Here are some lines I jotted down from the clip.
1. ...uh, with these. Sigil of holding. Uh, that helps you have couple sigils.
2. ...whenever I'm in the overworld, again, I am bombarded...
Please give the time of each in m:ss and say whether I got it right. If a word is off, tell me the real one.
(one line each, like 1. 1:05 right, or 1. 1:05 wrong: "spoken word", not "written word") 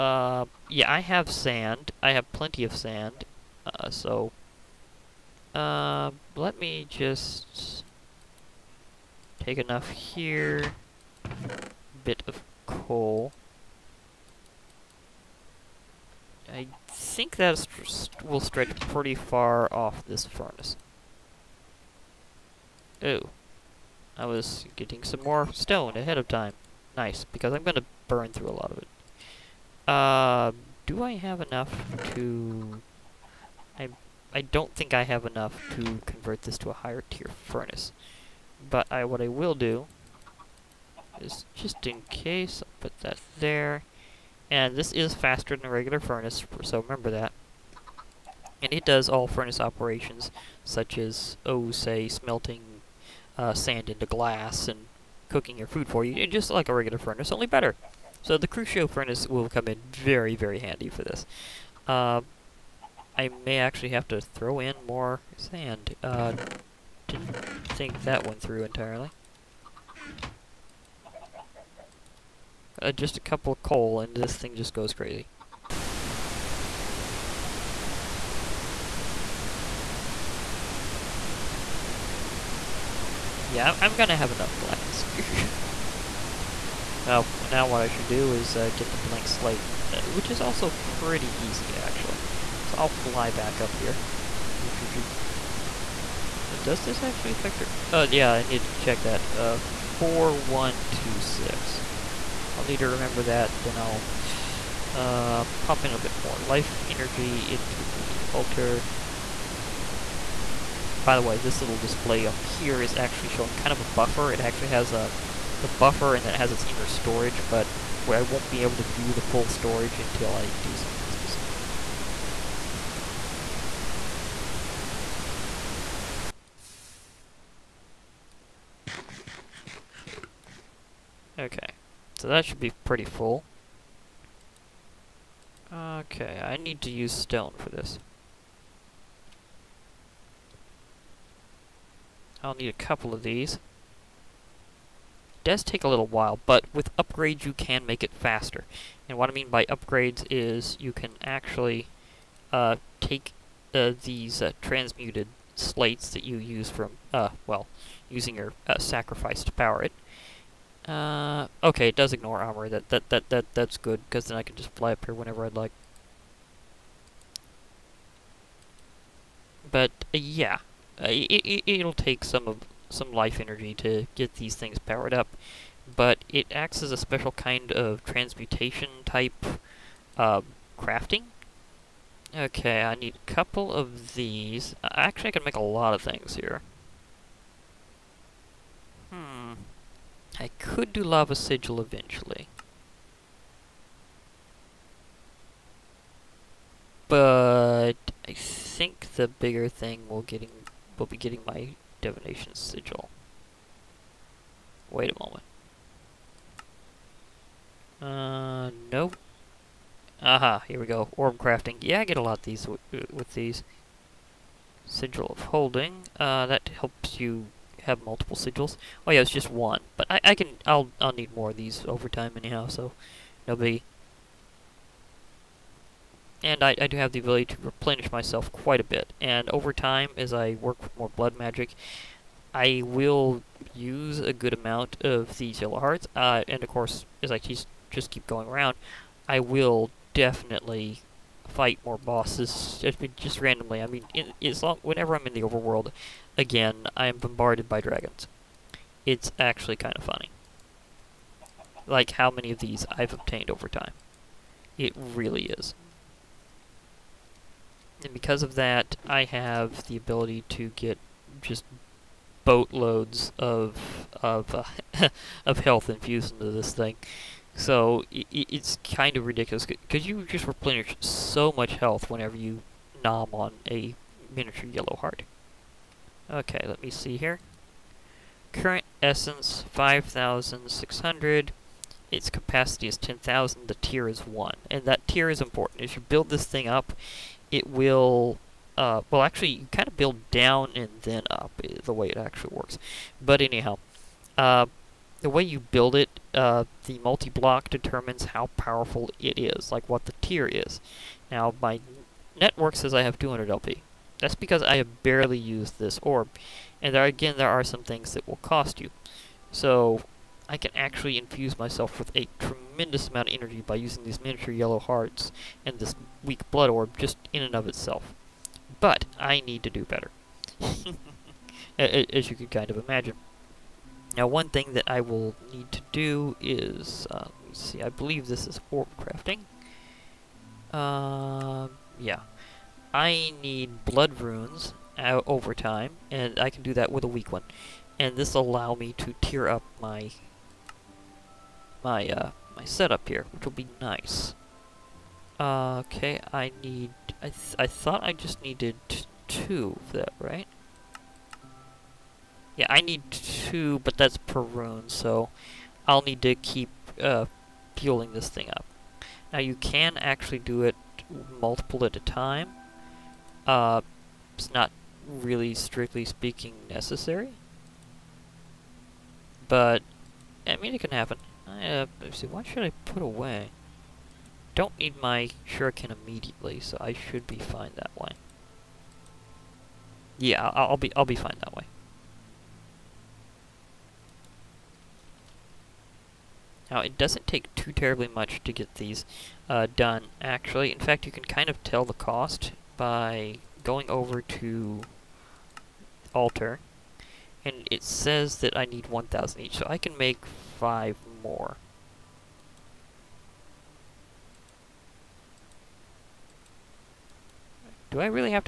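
1. 3:32 wrong: "multiple", not "couple"
2. 4:04 right.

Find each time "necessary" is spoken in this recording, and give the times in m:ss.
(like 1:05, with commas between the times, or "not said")
6:06.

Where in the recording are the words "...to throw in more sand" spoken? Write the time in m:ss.
1:04.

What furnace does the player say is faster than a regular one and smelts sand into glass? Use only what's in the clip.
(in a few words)
Crucio furnace.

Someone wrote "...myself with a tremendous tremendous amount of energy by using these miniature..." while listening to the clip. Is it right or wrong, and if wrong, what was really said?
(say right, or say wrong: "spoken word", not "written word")
right.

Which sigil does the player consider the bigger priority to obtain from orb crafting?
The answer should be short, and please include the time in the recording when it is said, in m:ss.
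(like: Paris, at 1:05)
divination sigil, at 3:22.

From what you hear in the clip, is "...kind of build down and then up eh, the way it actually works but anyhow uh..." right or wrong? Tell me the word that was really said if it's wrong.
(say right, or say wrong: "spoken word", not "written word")
right.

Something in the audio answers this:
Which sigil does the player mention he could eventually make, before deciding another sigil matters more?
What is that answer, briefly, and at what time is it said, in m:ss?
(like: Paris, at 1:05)
Lava Sigil, at 3:11.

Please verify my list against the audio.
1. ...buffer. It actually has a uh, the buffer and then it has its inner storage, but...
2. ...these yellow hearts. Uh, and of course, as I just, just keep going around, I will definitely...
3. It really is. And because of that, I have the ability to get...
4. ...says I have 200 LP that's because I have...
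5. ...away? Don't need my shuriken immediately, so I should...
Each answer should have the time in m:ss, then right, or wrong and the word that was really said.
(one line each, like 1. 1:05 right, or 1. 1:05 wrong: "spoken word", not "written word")
1. 1:53 right
2. 3:55 right
3. 4:14 right
4. 5:02 right
5. 6:13 right.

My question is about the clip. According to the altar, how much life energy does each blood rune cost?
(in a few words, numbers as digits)
1,000.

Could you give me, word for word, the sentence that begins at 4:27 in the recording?
So it, it's kind of ridiculous because you just replenish so much health whenever you nom on a miniature yellow heart.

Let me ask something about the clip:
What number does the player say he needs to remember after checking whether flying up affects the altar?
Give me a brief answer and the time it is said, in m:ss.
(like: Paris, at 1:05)
4126, at 1:39.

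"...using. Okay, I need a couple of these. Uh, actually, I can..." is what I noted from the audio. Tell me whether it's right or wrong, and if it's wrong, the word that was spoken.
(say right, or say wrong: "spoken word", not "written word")
wrong: "crafting", not "using".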